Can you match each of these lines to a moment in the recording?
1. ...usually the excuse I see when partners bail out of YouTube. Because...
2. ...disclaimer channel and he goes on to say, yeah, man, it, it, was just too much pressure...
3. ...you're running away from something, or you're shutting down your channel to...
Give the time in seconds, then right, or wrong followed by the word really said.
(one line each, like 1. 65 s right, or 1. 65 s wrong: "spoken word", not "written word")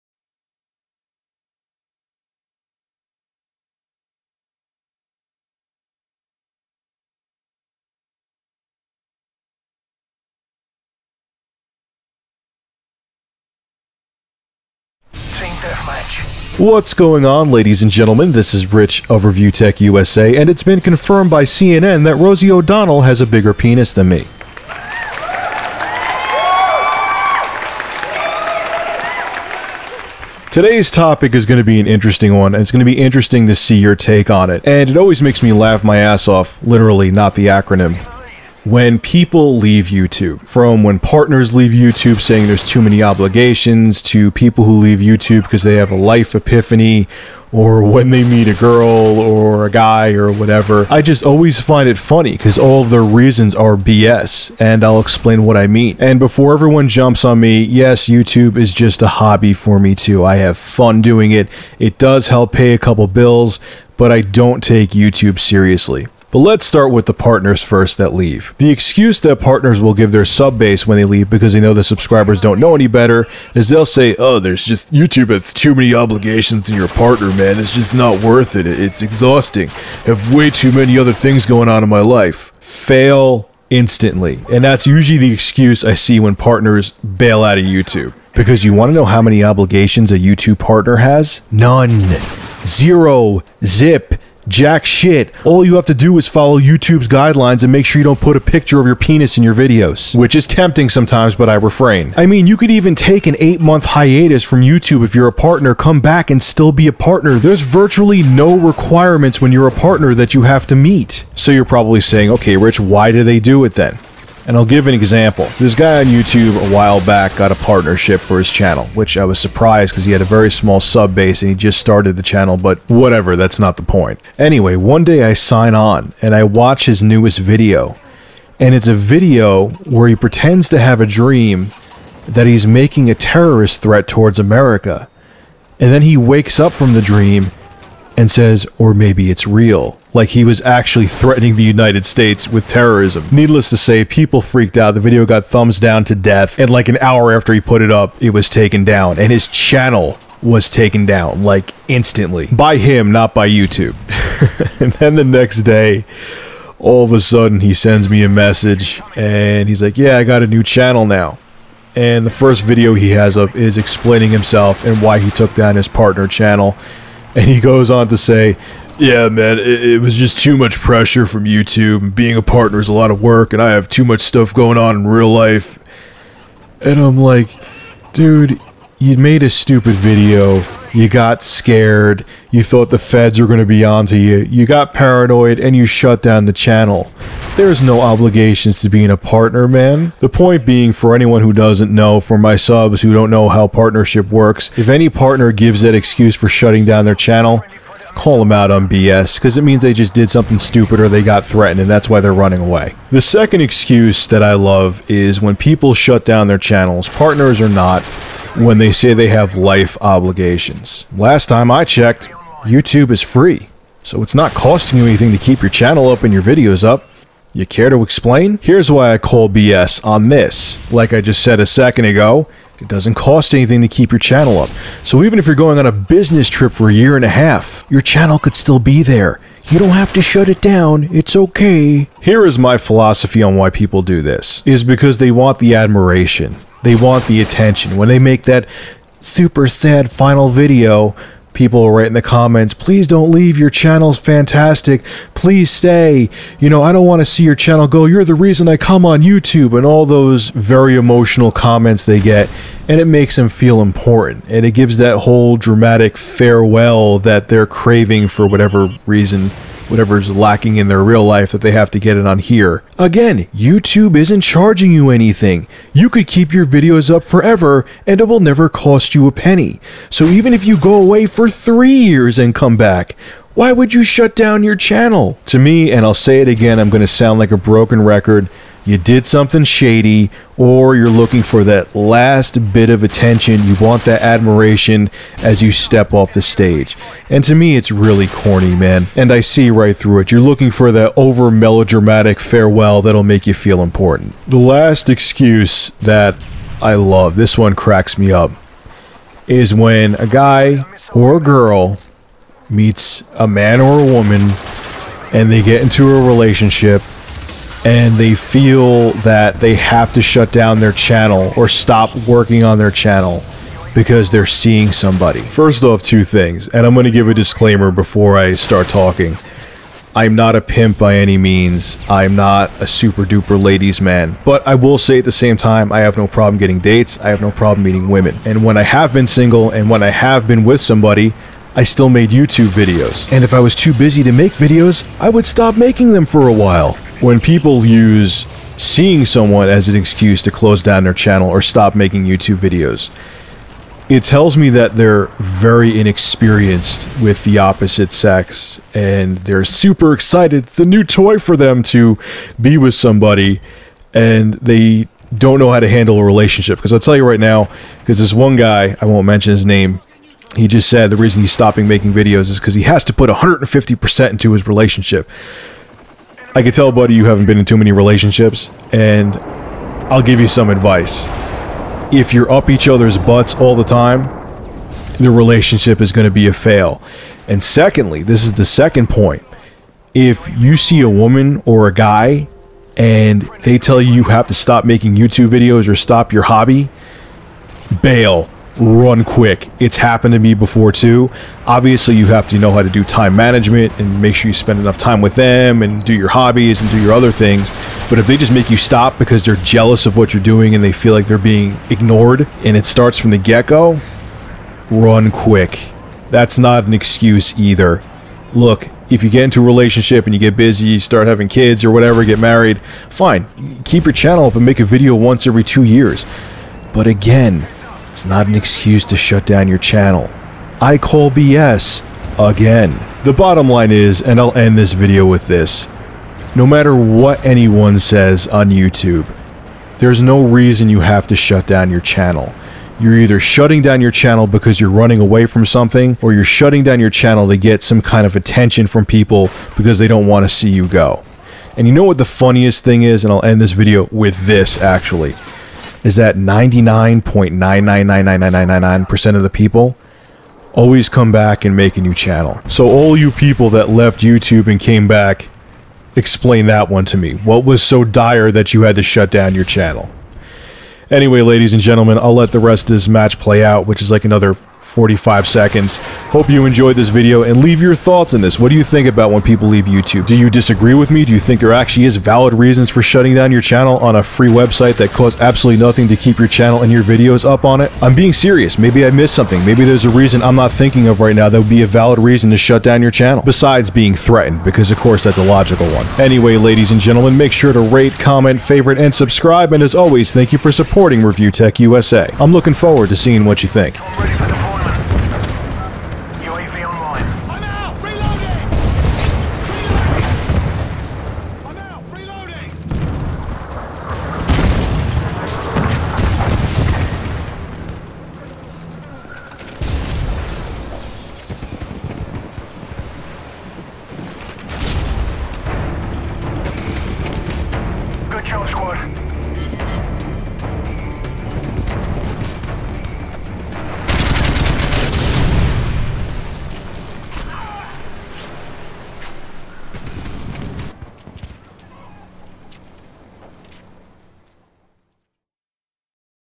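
1. 84 s right
2. 165 s wrong: "partner", not "disclaimer"
3. 434 s right.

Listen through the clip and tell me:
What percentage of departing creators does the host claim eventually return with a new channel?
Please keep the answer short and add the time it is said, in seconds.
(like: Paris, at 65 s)
99.9999999%, at 446 s.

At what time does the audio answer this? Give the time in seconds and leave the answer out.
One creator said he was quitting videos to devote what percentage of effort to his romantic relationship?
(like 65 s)
363 s.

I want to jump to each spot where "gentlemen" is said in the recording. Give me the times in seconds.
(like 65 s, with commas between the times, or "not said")
17 s, 461 s, 486 s.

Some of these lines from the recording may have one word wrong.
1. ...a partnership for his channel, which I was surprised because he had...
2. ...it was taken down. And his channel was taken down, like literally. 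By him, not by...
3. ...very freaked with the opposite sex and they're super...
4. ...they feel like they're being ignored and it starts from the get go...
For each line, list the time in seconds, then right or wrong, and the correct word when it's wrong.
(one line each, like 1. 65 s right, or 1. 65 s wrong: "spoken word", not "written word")
1. 117 s right
2. 148 s wrong: "instantly", not "literally"
3. 345 s wrong: "inexperienced", not "freaked"
4. 400 s right.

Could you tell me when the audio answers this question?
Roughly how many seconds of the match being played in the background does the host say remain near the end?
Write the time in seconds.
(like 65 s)
464 s.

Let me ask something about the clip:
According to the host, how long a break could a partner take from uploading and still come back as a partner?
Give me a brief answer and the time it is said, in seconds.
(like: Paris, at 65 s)
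8 months, at 103 s.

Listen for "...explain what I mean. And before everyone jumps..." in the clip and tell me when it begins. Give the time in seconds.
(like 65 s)
55 s.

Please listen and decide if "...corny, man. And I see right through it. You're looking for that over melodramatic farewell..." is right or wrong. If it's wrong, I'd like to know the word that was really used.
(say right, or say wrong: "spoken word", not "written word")
right.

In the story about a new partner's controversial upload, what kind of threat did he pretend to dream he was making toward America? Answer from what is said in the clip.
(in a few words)
Terrorist threat.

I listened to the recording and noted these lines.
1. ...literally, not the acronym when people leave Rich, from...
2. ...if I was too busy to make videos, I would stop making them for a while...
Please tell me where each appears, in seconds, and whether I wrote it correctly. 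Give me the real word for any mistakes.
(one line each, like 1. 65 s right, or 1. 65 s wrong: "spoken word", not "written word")
1. 36 s wrong: "YouTube", not "Rich"
2. 333 s right.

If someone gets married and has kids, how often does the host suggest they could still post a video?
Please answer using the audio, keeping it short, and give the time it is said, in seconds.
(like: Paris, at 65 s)
Once every two years, at 415 s.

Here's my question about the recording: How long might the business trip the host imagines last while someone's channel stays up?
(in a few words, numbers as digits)
A year and a half.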